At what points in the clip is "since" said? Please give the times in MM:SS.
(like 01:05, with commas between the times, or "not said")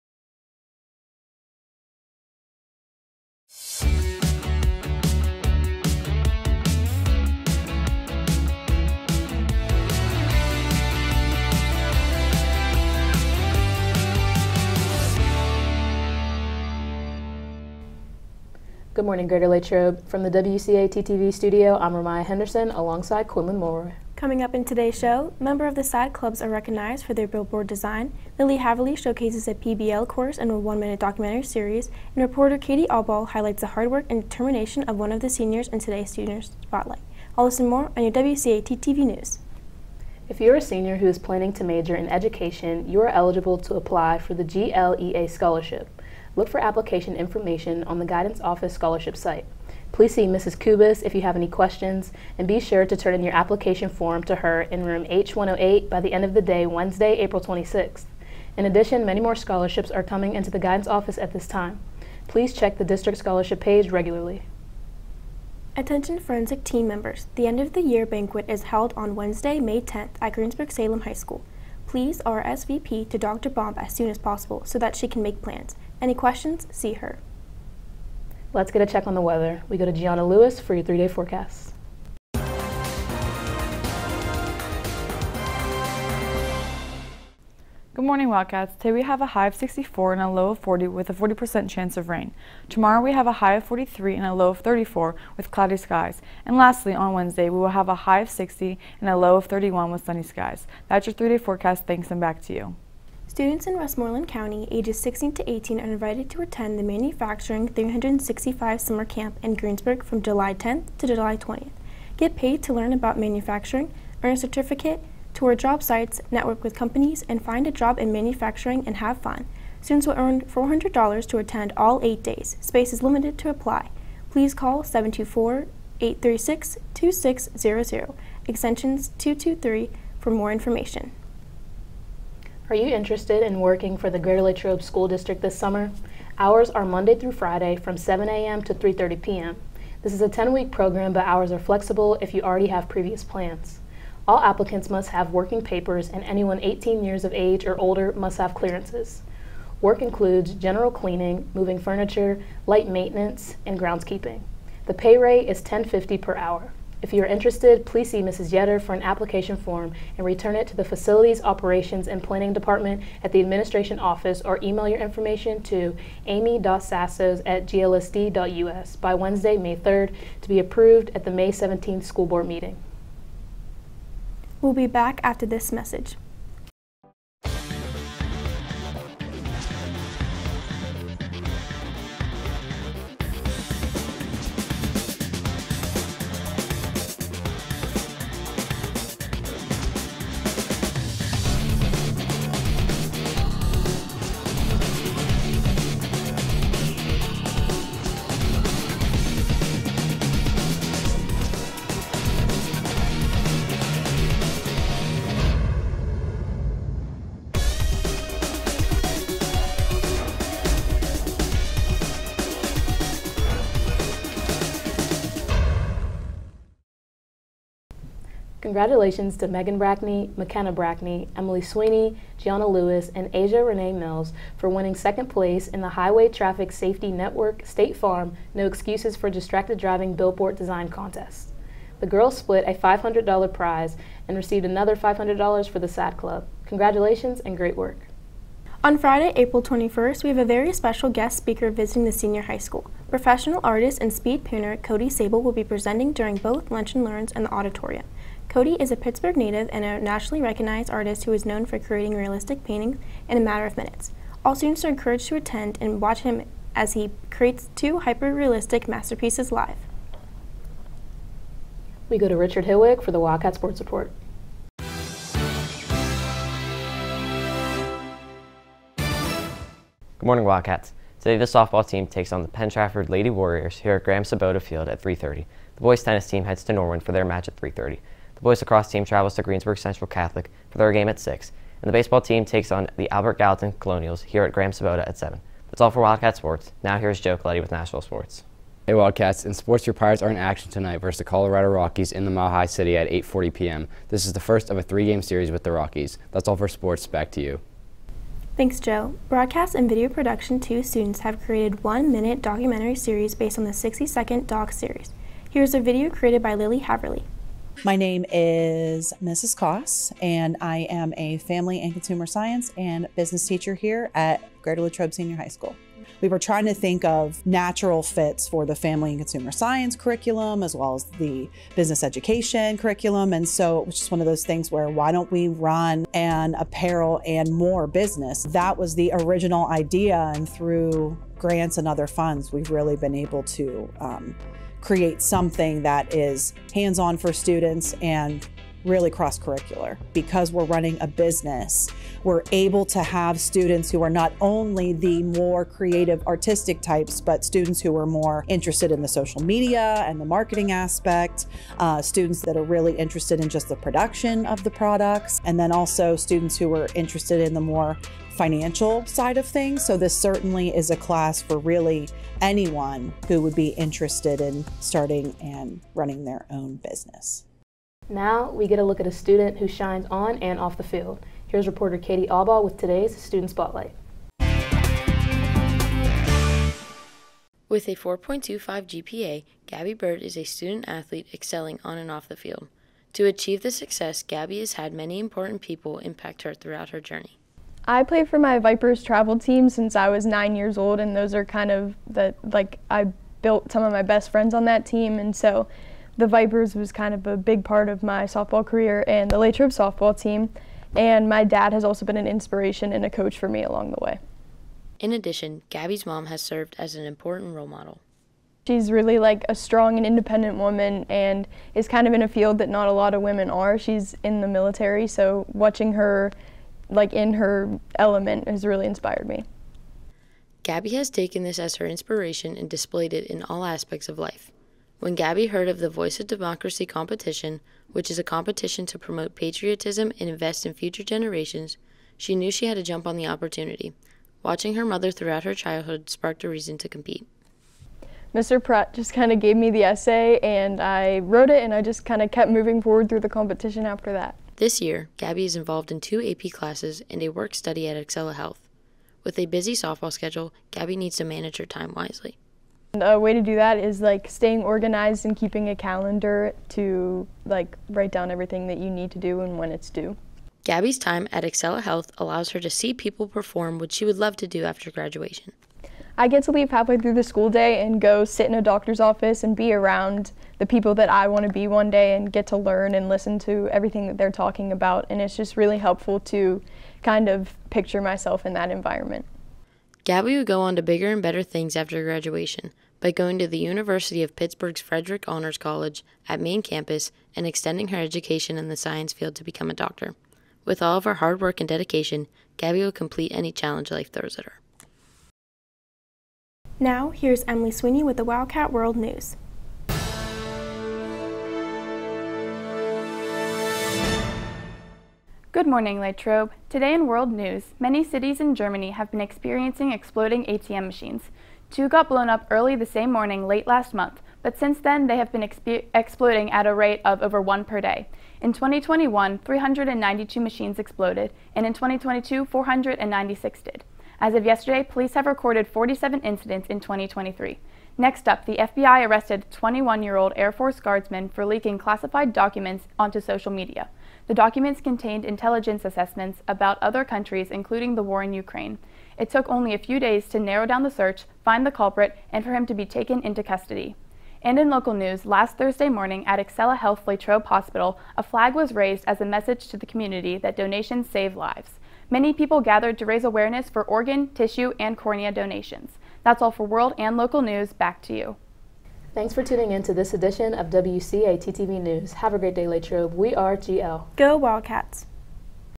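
06:29, 08:34.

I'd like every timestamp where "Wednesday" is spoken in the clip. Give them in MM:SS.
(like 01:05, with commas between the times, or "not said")
00:56, 01:09, 01:37, 02:49.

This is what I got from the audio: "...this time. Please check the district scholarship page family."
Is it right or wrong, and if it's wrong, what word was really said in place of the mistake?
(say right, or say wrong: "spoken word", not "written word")
wrong: "regularly", not "family".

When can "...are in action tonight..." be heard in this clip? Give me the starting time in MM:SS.
04:50.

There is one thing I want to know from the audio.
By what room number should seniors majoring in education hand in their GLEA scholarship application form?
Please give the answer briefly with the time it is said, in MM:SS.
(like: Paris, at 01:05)
H108, at 00:55.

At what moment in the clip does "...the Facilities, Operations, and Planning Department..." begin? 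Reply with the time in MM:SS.
02:40.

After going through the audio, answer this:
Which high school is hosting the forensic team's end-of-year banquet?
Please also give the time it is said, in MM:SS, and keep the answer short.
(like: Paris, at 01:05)
Greensburg-Salem High School, at 01:10.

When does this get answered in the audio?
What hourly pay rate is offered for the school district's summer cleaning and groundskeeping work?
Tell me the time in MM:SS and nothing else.
02:35.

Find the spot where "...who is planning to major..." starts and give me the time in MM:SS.
00:40.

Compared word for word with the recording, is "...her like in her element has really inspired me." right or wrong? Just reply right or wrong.
right.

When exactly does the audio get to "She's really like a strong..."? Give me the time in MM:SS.
06:48.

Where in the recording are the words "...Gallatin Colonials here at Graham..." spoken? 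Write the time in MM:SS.
04:43.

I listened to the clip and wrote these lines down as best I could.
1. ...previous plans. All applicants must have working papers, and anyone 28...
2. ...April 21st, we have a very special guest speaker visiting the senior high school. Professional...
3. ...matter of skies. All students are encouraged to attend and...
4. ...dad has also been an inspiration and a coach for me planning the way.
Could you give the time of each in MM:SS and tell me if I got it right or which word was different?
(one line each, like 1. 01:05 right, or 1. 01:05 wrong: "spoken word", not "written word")
1. 02:22 wrong: "18", not "28"
2. 03:59 right
3. 04:13 wrong: "minutes", not "skies"
4. 06:41 wrong: "along", not "planning".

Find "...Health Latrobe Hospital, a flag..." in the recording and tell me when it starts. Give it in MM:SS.
09:06.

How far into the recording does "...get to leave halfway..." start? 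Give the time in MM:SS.
07:46.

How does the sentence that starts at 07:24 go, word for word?
This year, Gabby is involved in two AP classes and a work study at Excela Health.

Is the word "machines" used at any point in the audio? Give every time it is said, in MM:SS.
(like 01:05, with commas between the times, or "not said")
08:30, 08:40.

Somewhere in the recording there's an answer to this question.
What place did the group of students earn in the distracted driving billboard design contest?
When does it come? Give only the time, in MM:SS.
03:44.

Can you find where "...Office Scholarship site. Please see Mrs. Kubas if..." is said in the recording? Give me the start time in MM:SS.
00:48.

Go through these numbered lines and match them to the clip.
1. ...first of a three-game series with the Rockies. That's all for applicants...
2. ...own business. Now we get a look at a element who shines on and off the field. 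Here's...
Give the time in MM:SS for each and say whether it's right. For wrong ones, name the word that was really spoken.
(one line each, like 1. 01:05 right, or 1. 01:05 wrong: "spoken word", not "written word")
1. 04:54 wrong: "sports", not "applicants"
2. 06:06 wrong: "student", not "element".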